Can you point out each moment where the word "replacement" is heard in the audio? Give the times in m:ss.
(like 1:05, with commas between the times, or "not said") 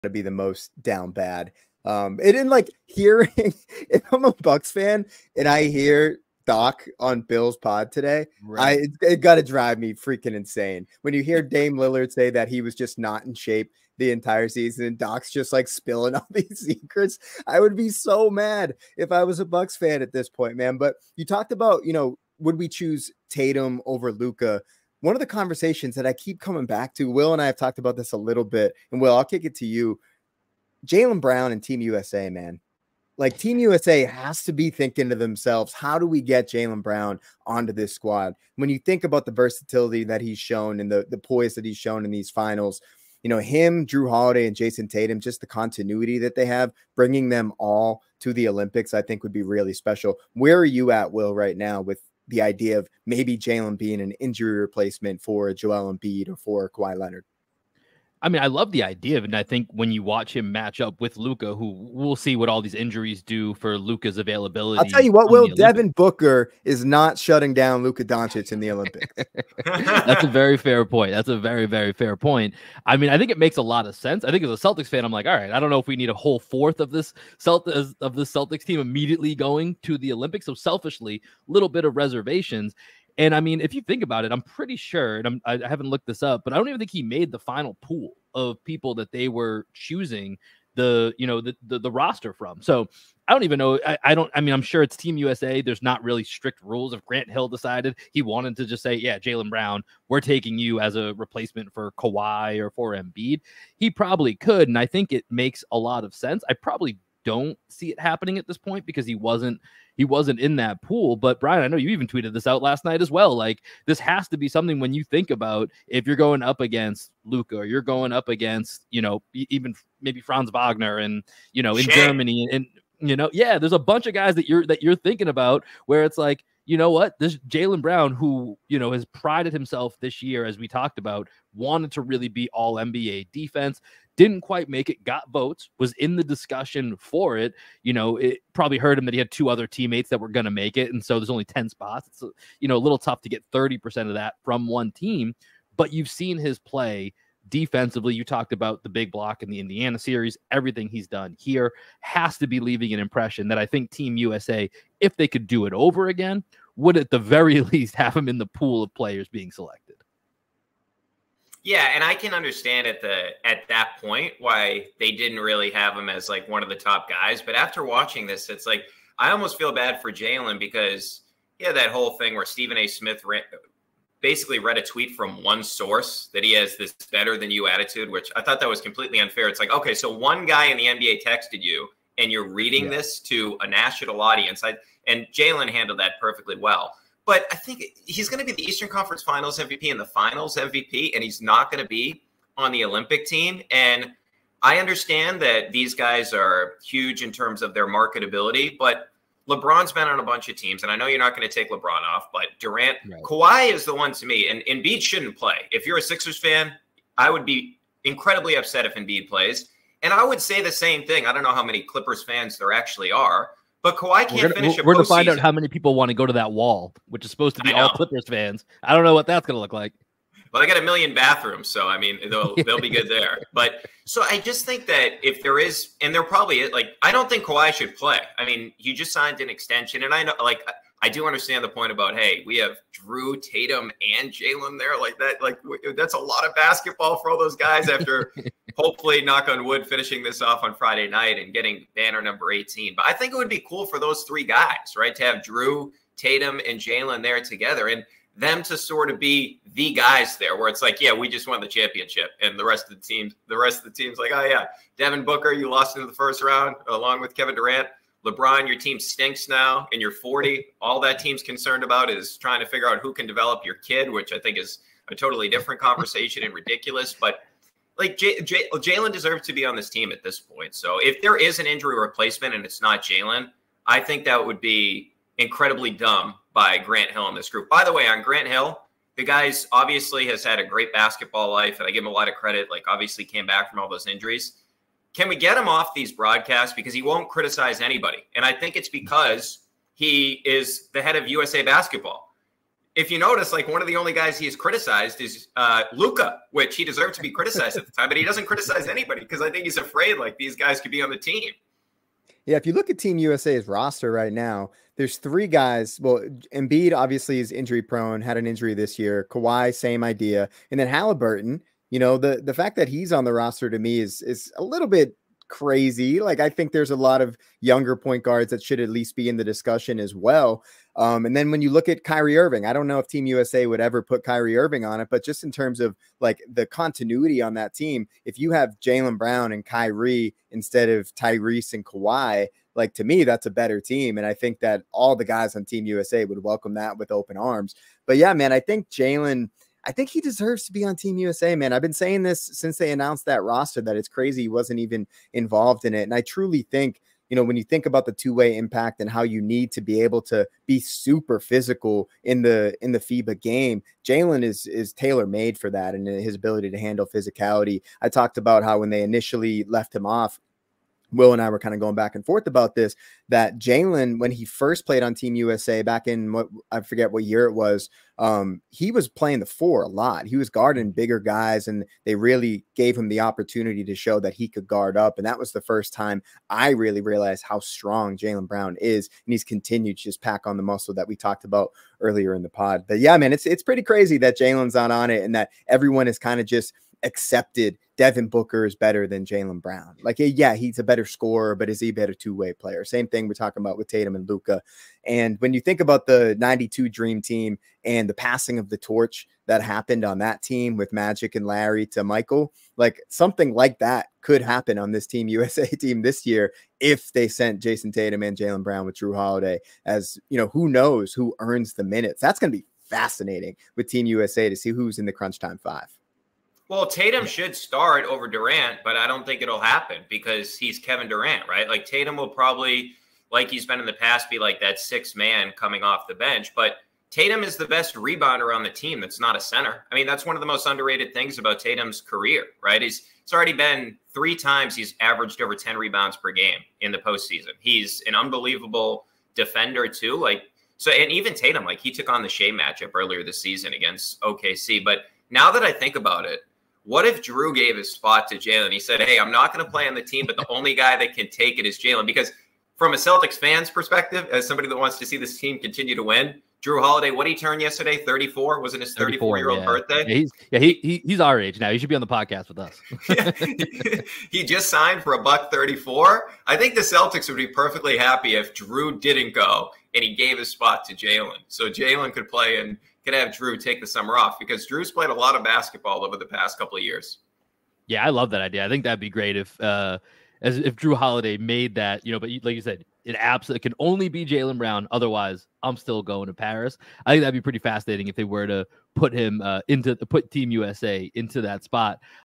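0:54, 1:41, 4:31.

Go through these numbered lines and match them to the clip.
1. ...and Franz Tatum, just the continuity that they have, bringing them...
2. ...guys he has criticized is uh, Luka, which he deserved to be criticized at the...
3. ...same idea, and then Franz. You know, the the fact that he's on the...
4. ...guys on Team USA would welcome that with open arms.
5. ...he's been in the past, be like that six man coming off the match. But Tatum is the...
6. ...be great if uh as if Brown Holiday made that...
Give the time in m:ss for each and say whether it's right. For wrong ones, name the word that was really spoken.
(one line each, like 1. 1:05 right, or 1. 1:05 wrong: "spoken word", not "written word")
1. 0:44 wrong: "Jayson", not "Franz"
2. 4:54 right
3. 5:09 wrong: "Halliburton", not "Franz"
4. 5:35 right
5. 7:03 wrong: "bench", not "match"
6. 7:58 wrong: "Jrue", not "Brown".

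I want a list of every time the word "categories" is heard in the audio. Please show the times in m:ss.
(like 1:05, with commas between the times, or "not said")
not said.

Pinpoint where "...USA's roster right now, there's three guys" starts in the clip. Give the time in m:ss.
5:03.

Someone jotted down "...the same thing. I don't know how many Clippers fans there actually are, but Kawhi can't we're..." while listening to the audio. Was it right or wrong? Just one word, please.
right.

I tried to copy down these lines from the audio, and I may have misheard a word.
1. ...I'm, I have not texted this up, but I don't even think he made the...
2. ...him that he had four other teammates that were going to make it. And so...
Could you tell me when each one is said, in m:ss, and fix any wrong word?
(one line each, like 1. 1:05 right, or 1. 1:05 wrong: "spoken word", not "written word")
1. 1:25 wrong: "looked", not "texted"
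2. 2:18 wrong: "two", not "four".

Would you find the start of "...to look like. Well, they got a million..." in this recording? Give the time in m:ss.
3:39.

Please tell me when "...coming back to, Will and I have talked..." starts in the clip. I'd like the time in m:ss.
0:26.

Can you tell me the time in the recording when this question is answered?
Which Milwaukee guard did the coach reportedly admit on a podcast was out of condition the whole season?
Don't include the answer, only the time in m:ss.
0:11.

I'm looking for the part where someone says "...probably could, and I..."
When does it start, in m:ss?
1:43.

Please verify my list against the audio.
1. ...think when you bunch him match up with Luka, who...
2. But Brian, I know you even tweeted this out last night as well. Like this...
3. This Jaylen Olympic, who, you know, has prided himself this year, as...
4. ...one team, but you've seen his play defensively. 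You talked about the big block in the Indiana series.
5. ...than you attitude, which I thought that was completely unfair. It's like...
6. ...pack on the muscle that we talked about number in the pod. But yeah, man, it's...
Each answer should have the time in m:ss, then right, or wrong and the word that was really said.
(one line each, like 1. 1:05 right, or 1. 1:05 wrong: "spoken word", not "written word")
1. 0:59 wrong: "watch", not "bunch"
2. 1:51 right
3. 2:07 wrong: "Brown", not "Olympic"
4. 2:24 right
5. 2:57 right
6. 6:20 wrong: "earlier", not "number".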